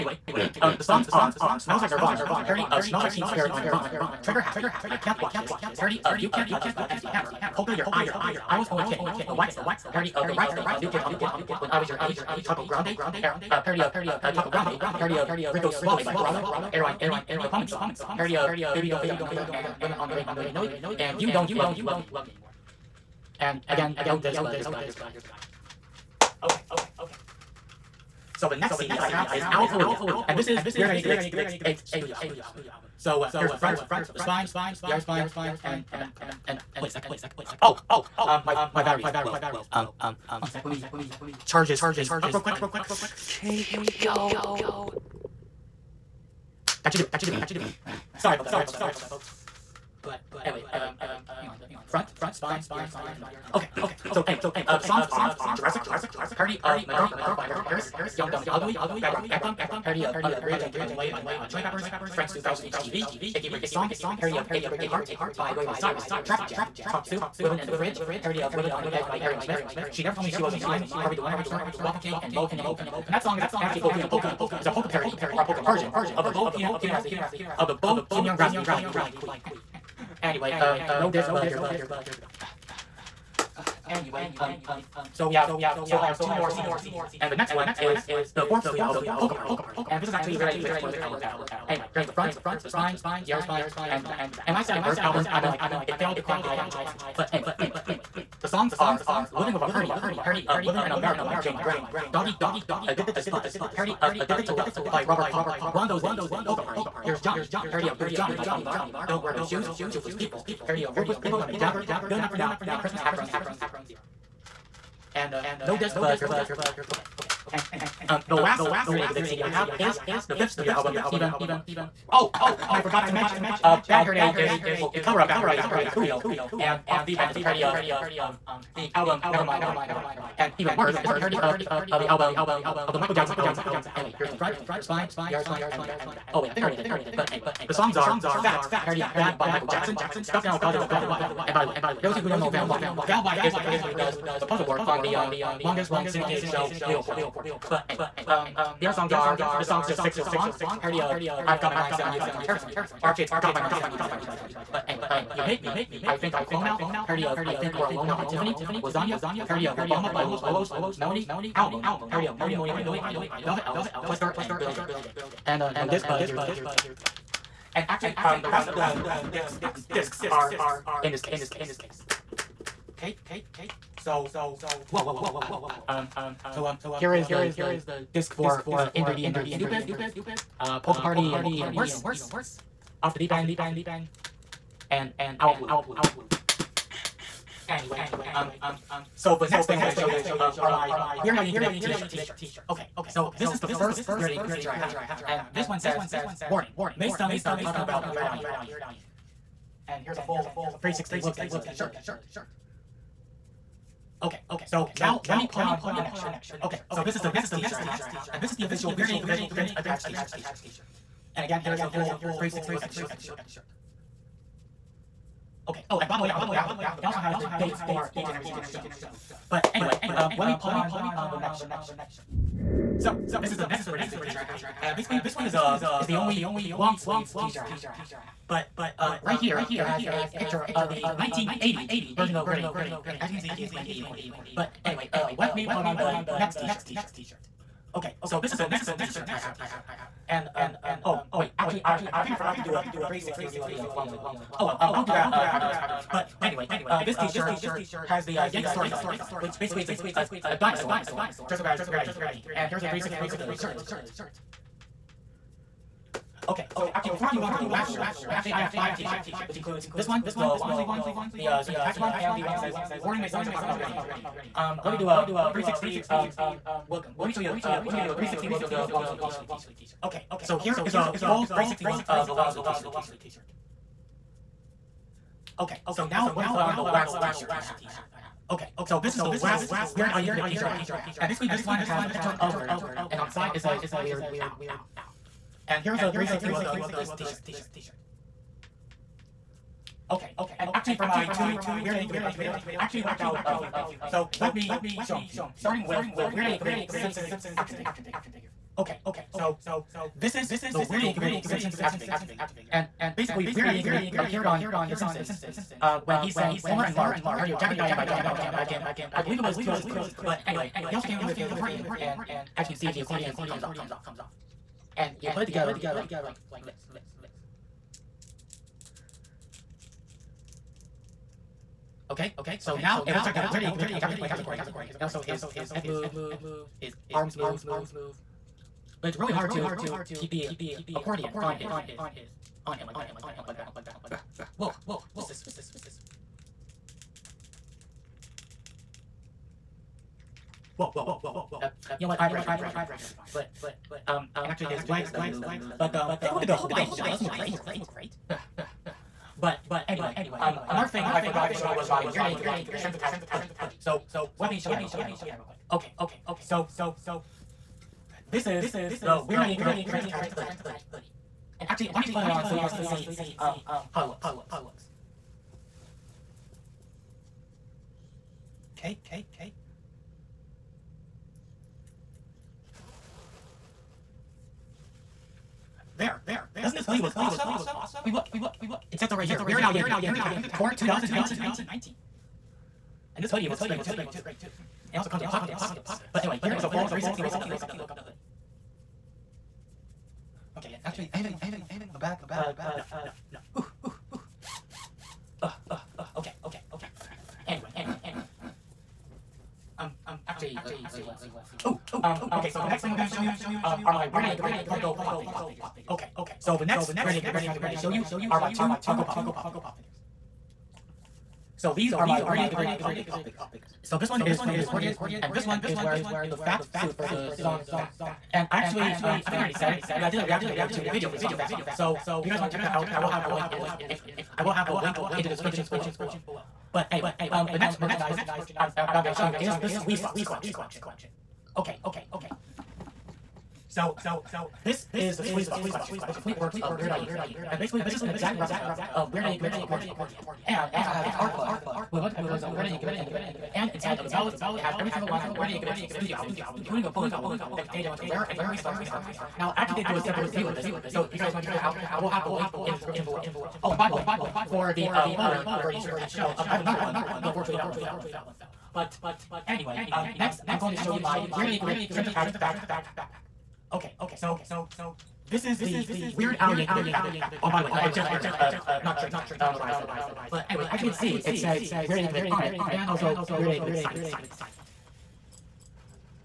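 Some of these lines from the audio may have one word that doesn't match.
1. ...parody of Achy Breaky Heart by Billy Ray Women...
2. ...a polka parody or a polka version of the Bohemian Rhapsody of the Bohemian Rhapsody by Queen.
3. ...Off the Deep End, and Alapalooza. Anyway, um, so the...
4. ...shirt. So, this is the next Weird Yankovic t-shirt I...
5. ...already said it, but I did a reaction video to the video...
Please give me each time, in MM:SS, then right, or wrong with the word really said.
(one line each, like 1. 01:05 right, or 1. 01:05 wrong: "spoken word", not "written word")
1. 01:04 wrong: "Cyrus", not "Women"
2. 01:14 right
3. 03:03 right
4. 03:41 right
5. 06:59 right.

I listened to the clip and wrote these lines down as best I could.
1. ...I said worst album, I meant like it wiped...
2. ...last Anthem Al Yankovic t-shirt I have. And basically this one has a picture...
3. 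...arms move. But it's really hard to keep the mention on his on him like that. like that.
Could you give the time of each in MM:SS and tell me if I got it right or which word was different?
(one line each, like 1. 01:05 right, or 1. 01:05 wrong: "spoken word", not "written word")
1. 01:34 wrong: "failed", not "wiped"
2. 04:39 wrong: "Weird", not "Anthem"
3. 05:27 wrong: "accordion", not "mention".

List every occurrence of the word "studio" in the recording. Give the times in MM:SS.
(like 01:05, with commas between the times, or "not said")
00:31, 01:28, 02:00, 07:25.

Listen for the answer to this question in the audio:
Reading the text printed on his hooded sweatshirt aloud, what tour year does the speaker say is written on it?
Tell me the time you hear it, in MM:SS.
06:20.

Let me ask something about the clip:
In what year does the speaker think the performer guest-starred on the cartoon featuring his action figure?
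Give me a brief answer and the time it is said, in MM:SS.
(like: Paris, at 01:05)
2003, at 05:09.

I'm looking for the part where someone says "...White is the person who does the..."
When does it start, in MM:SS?
02:23.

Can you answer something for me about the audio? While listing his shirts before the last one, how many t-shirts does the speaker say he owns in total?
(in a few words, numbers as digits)
5.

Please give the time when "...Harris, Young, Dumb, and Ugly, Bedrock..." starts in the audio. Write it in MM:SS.
00:57.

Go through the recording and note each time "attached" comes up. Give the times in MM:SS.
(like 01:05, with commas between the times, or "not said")
03:29, 04:21, 05:52, 06:00, 06:20, 07:35, 07:42, 07:49.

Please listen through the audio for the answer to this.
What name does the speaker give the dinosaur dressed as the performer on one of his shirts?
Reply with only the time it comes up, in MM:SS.
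04:08.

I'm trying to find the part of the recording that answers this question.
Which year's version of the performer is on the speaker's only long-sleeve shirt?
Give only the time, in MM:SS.
03:51.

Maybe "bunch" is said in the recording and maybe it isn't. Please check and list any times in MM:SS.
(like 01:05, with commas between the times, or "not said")
07:21, 07:27.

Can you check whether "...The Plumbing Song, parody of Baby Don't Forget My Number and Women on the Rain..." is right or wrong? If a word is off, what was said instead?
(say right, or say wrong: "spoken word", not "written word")
right.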